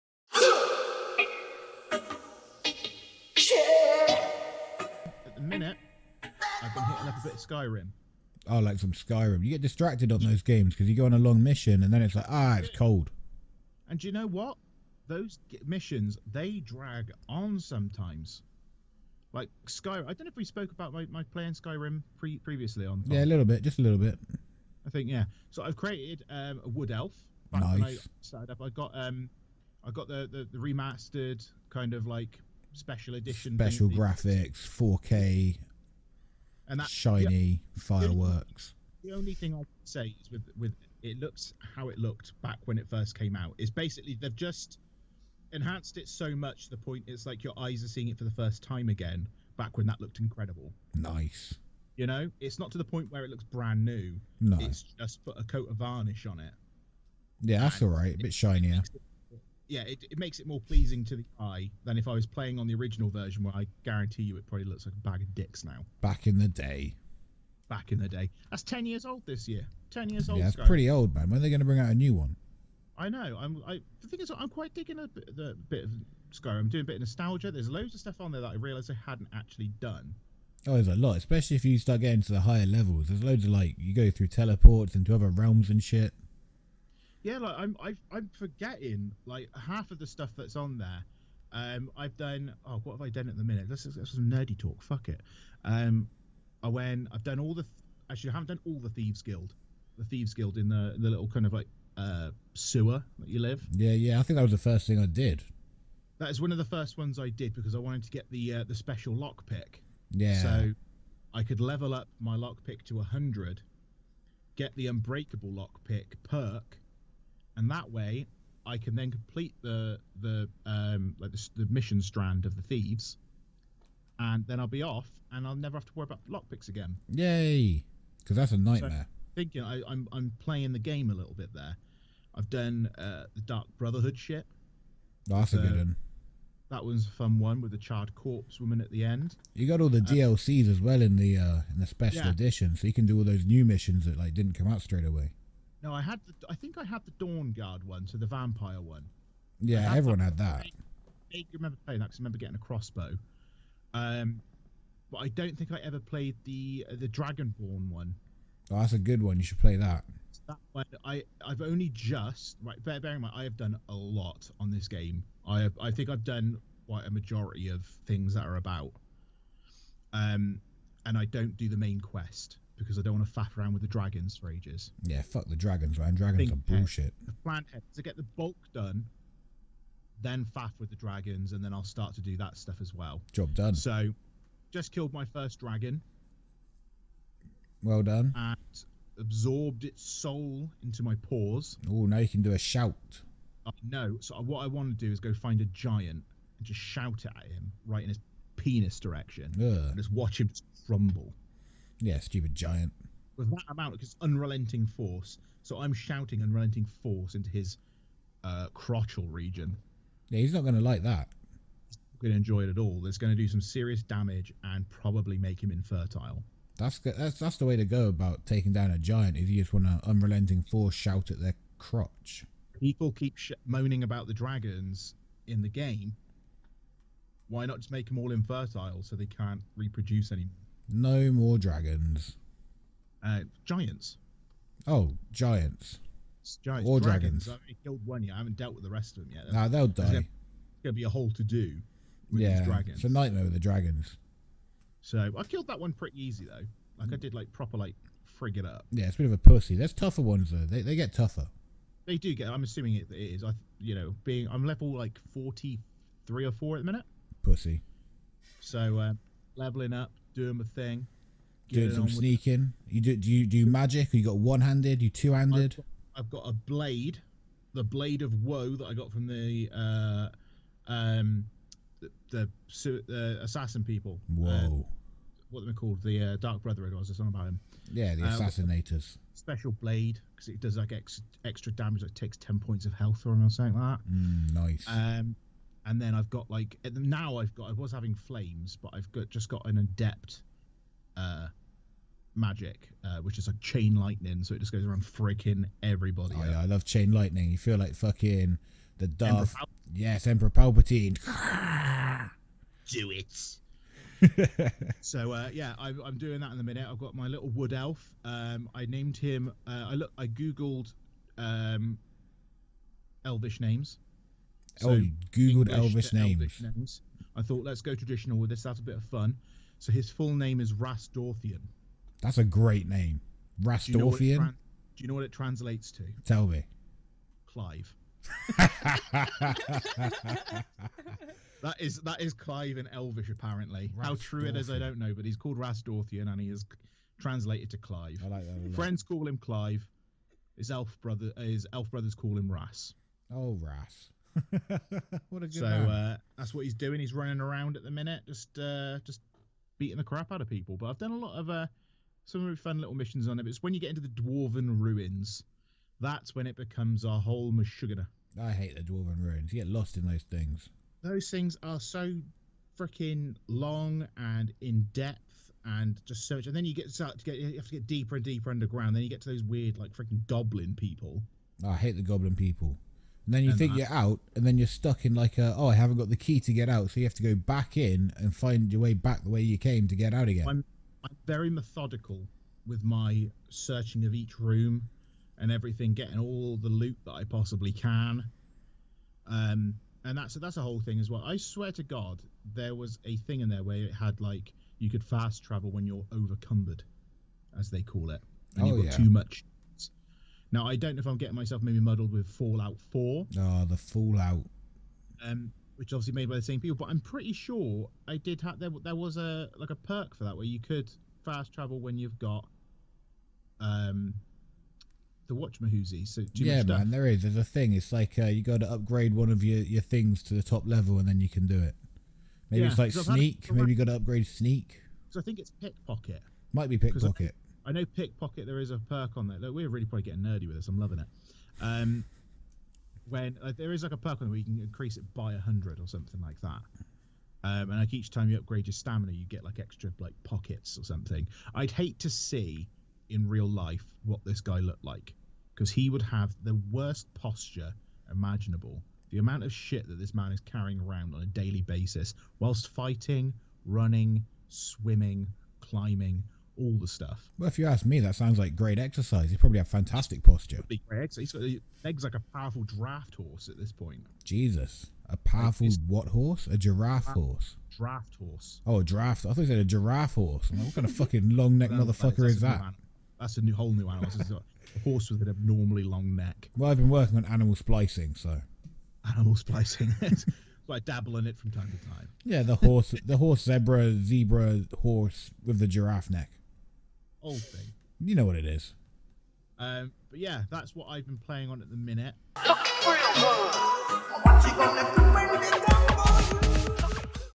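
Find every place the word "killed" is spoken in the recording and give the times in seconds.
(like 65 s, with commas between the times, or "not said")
184 s, 237 s, 245 s.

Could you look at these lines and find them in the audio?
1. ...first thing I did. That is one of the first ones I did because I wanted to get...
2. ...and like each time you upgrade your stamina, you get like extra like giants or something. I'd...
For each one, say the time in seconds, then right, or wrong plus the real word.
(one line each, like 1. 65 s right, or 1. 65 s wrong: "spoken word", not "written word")
1. 104 s right
2. 437 s wrong: "pockets", not "giants".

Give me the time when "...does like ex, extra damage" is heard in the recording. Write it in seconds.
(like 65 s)
280 s.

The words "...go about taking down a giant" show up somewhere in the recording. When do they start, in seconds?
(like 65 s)
217 s.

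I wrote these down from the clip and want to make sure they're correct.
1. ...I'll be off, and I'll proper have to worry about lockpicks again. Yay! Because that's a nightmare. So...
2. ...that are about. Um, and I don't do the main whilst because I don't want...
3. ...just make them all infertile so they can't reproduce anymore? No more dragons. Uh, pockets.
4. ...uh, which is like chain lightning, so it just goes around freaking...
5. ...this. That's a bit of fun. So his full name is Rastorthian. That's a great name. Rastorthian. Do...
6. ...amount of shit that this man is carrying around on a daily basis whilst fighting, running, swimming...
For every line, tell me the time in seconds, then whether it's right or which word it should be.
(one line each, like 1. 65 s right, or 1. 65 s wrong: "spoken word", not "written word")
1. 124 s wrong: "never", not "proper"
2. 168 s wrong: "quest", not "whilst"
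3. 227 s wrong: "giants", not "pockets"
4. 293 s right
5. 318 s right
6. 449 s right.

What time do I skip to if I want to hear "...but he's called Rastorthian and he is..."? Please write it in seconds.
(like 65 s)
335 s.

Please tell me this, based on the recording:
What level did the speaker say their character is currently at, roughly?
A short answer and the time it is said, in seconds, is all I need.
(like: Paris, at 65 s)
43, at 255 s.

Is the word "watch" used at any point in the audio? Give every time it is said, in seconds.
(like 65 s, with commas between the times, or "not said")
200 s, 415 s.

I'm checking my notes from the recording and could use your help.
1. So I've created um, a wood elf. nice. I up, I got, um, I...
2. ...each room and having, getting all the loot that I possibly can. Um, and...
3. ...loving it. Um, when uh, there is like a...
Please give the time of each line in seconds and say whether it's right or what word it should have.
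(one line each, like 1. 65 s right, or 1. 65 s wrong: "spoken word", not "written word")
1. 25 s right
2. 384 s wrong: "everything", not "having"
3. 430 s right.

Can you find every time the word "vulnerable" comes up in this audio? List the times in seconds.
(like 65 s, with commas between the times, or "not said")
not said.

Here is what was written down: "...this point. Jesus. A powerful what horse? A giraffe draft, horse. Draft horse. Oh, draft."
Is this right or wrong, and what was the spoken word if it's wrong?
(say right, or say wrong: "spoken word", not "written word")
right.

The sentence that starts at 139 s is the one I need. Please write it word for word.
You got all the uh, DLCs as well in the uh, in the special yeah.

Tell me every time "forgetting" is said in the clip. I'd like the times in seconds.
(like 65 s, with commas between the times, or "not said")
88 s.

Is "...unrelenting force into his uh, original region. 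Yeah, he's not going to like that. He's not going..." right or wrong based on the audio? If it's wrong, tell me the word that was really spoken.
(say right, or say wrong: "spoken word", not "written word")
wrong: "crotchal", not "original".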